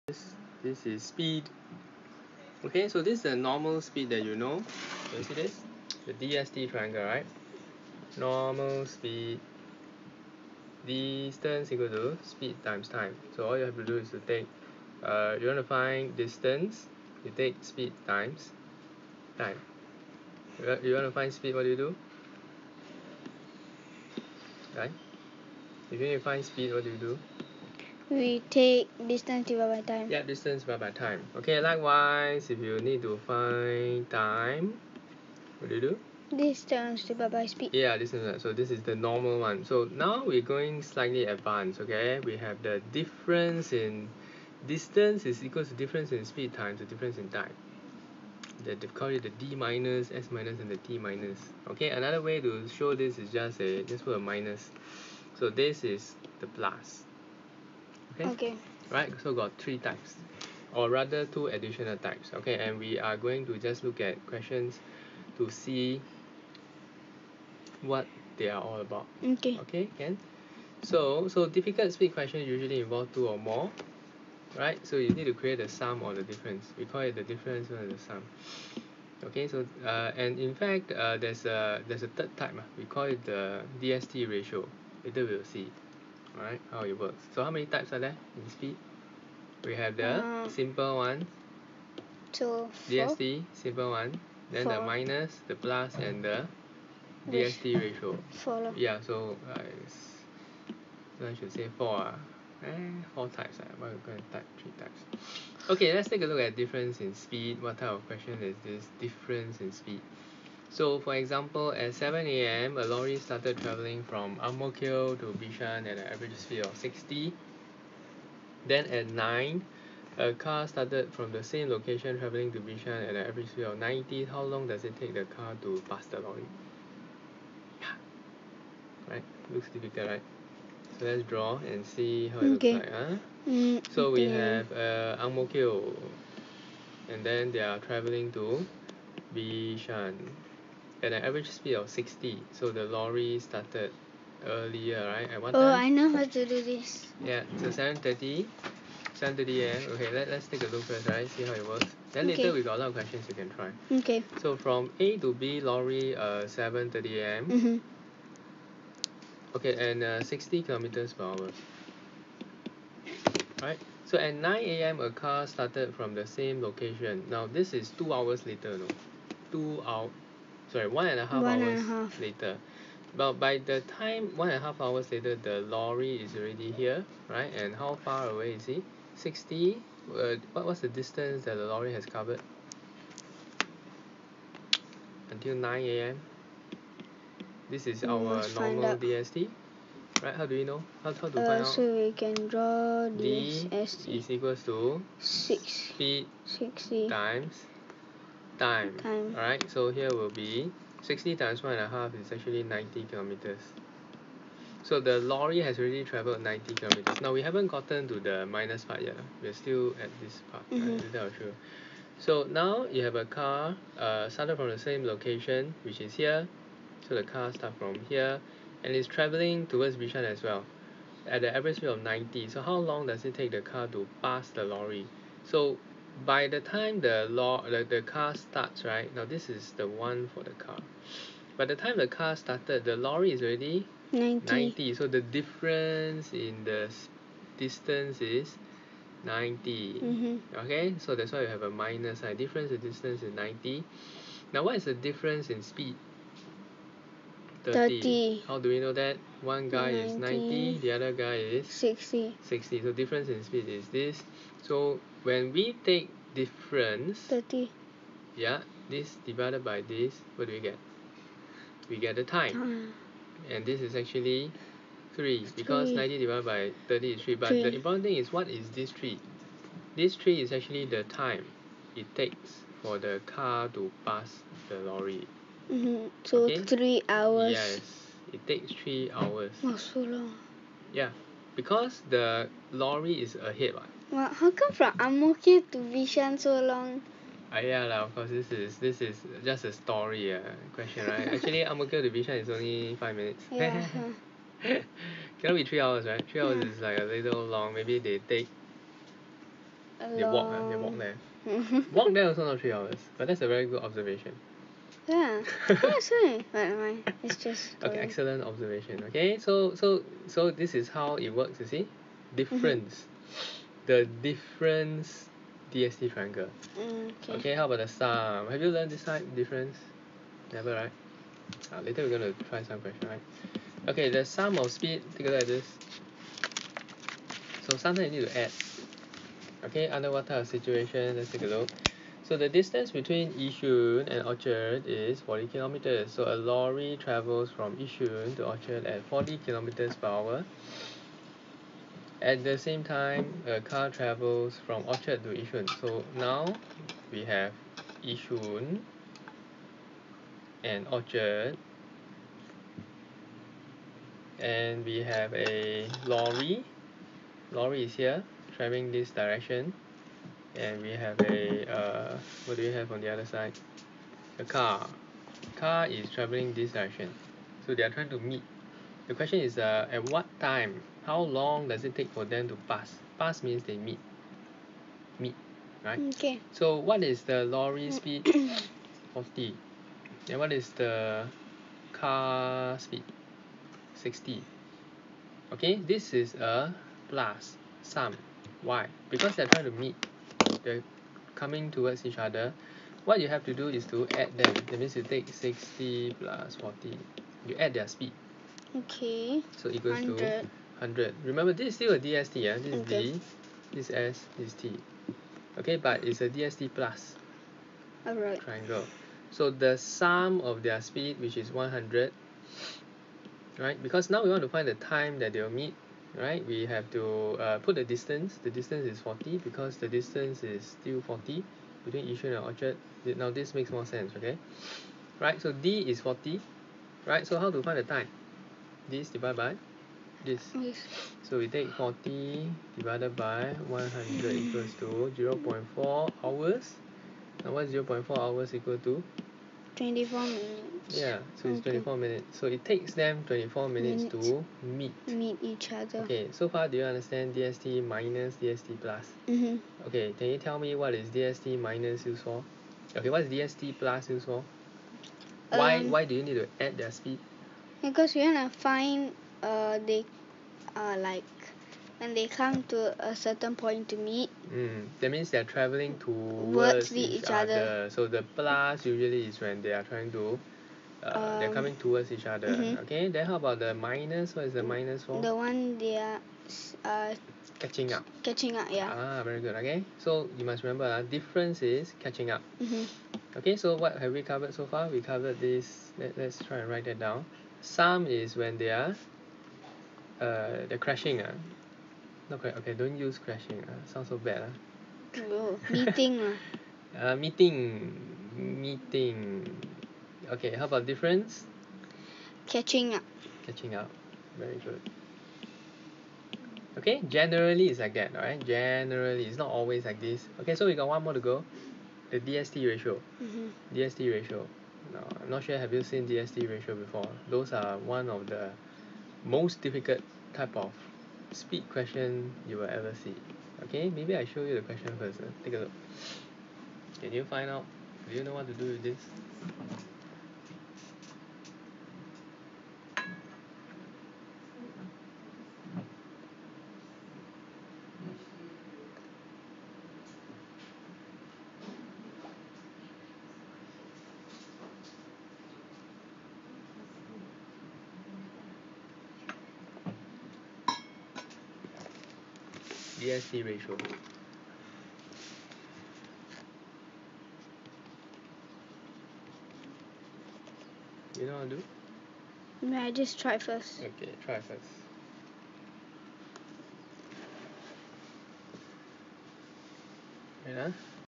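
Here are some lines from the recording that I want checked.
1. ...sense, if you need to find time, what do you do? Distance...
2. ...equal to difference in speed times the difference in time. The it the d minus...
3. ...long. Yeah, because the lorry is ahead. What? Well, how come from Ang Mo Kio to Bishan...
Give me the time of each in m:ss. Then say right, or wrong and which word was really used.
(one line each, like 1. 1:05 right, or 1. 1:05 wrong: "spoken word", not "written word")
1. 0:31 wrong: "likewise", not "sense"
2. 0:45 right
3. 4:40 right.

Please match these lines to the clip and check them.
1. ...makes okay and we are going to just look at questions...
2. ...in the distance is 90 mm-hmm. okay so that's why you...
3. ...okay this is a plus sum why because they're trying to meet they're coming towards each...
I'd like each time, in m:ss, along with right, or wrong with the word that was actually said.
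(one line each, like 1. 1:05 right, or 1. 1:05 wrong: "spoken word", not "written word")
1. 1:01 wrong: "types", not "makes"
2. 3:56 right
3. 6:25 right.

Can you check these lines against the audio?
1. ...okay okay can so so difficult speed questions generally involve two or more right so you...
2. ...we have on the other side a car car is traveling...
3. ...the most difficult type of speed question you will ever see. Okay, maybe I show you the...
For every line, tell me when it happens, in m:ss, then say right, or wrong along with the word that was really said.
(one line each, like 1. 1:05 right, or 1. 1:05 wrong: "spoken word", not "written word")
1. 1:09 wrong: "usually", not "generally"
2. 6:02 right
3. 8:38 right.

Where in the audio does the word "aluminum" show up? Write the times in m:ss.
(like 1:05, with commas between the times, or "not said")
not said.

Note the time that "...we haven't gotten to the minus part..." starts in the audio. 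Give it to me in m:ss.
3:27.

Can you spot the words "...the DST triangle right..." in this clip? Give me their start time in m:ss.
0:06.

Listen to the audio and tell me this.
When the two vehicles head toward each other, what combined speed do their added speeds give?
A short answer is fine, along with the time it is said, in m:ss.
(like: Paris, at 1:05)
100, at 6:39.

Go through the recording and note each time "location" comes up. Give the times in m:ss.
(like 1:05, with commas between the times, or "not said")
2:01, 2:46, 3:35.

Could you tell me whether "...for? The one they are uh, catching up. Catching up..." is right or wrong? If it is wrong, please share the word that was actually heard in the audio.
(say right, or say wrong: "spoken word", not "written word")
right.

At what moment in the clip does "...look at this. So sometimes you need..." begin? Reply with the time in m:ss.
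5:25.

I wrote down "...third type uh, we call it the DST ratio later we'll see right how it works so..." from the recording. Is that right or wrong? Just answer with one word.
right.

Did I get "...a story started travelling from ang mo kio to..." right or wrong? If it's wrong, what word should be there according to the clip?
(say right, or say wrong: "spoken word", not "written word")
wrong: "lorry", not "story".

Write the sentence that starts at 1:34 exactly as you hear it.
the minus the plus and the DST ratio four yeah so so I should say four uh, eh, four types uh, ah.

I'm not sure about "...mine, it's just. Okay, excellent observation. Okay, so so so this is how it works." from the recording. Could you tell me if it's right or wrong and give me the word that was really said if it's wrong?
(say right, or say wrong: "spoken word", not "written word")
right.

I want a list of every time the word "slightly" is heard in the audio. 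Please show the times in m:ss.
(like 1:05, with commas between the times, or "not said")
0:40.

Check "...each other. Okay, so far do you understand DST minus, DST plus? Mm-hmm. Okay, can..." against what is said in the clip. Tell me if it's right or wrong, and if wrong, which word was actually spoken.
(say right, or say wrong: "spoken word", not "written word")
right.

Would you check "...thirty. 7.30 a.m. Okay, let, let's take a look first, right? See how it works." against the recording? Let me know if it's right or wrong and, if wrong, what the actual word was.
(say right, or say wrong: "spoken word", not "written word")
right.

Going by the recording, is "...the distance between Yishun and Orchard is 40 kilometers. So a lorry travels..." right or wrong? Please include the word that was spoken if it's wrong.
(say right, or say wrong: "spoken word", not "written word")
right.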